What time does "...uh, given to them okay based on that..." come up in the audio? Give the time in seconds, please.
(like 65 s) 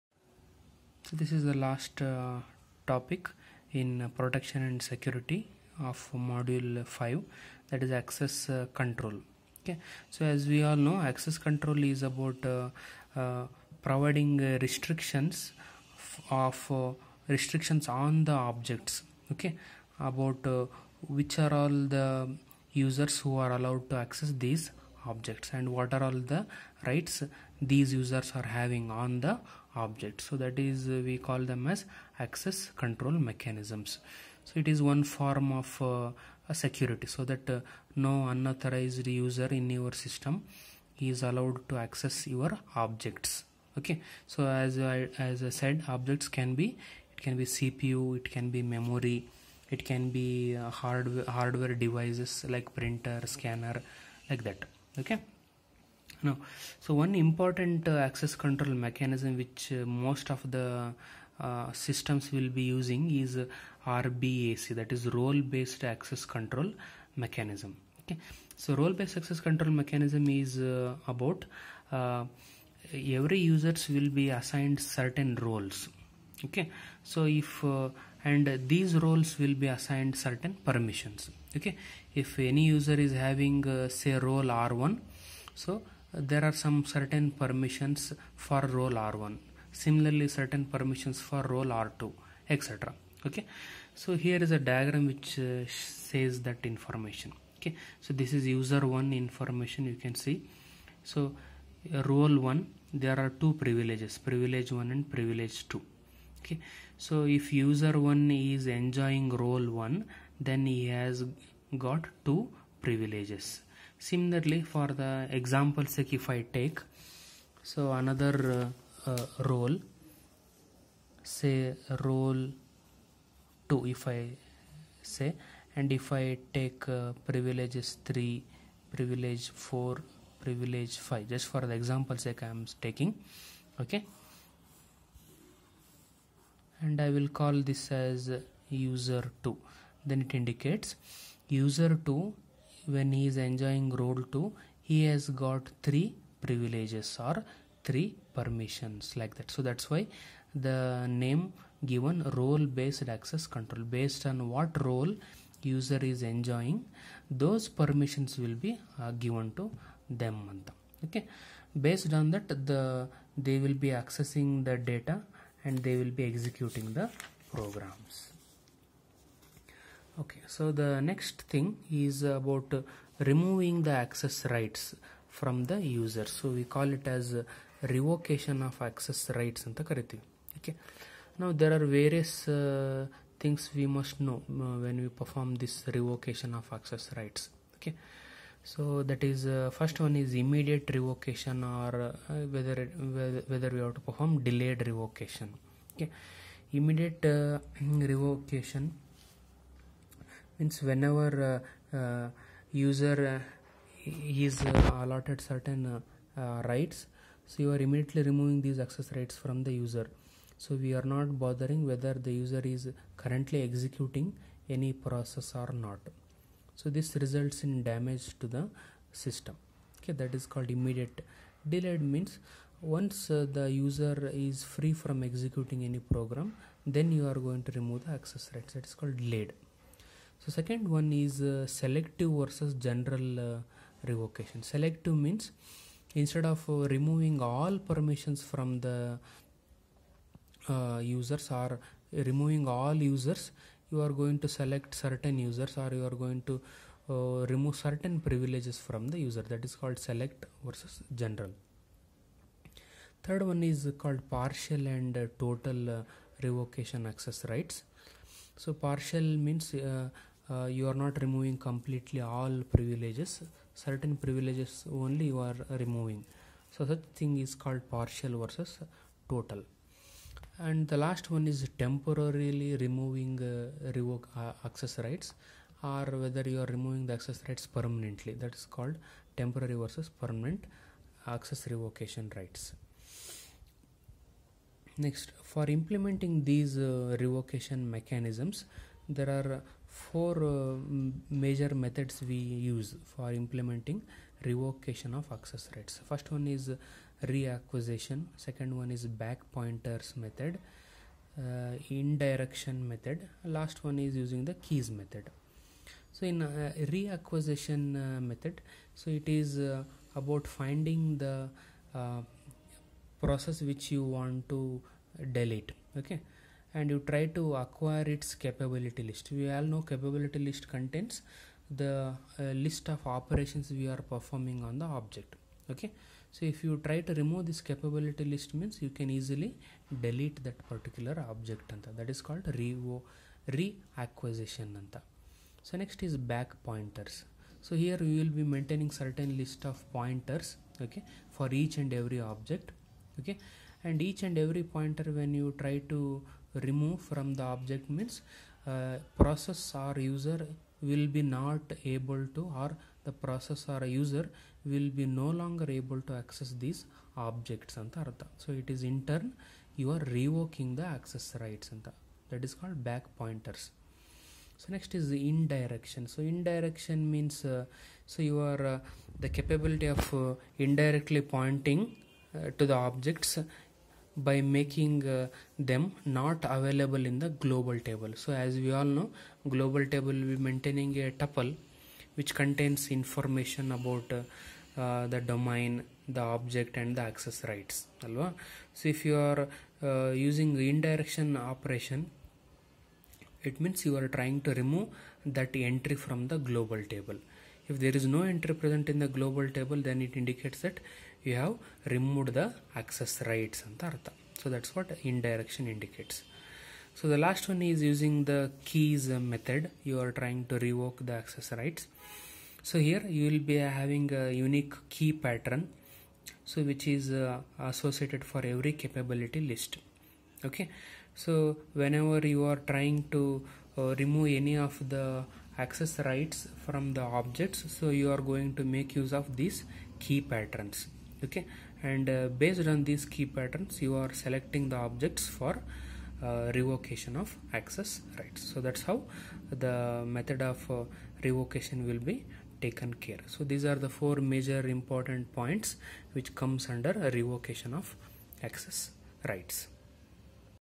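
158 s.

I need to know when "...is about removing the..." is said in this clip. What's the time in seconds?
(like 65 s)
171 s.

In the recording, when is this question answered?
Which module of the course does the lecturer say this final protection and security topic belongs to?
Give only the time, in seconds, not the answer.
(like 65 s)
6 s.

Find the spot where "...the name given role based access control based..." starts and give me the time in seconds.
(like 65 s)
150 s.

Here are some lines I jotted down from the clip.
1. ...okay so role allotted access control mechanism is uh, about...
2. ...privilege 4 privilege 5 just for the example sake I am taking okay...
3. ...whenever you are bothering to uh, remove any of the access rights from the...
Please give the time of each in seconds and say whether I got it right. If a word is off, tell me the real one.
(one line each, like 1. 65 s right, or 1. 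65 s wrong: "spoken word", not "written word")
1. 68 s wrong: "based", not "allotted"
2. 128 s right
3. 421 s wrong: "trying", not "bothering".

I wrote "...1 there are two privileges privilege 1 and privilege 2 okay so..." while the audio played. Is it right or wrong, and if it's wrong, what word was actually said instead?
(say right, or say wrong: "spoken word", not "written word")
right.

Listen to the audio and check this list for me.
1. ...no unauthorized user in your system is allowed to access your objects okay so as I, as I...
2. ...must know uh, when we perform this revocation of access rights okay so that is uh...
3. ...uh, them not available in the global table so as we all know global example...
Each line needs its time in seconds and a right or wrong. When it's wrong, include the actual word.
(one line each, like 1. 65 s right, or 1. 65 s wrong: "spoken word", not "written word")
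1. 37 s right
2. 183 s right
3. 375 s wrong: "table", not "example".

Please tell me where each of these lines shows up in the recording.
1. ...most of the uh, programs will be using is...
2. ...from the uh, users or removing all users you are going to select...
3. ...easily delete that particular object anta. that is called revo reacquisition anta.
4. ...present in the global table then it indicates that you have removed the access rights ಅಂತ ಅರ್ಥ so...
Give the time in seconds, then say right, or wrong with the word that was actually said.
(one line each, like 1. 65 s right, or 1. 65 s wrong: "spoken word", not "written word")
1. 59 s wrong: "systems", not "programs"
2. 238 s right
3. 329 s right
4. 398 s right.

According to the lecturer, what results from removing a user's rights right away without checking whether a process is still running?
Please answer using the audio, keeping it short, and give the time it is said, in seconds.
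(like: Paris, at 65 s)
damage to the system, at 217 s.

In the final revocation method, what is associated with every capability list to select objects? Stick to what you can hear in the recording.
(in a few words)
unique key pattern.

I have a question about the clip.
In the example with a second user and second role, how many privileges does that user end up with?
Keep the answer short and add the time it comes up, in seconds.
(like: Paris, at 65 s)
3, at 145 s.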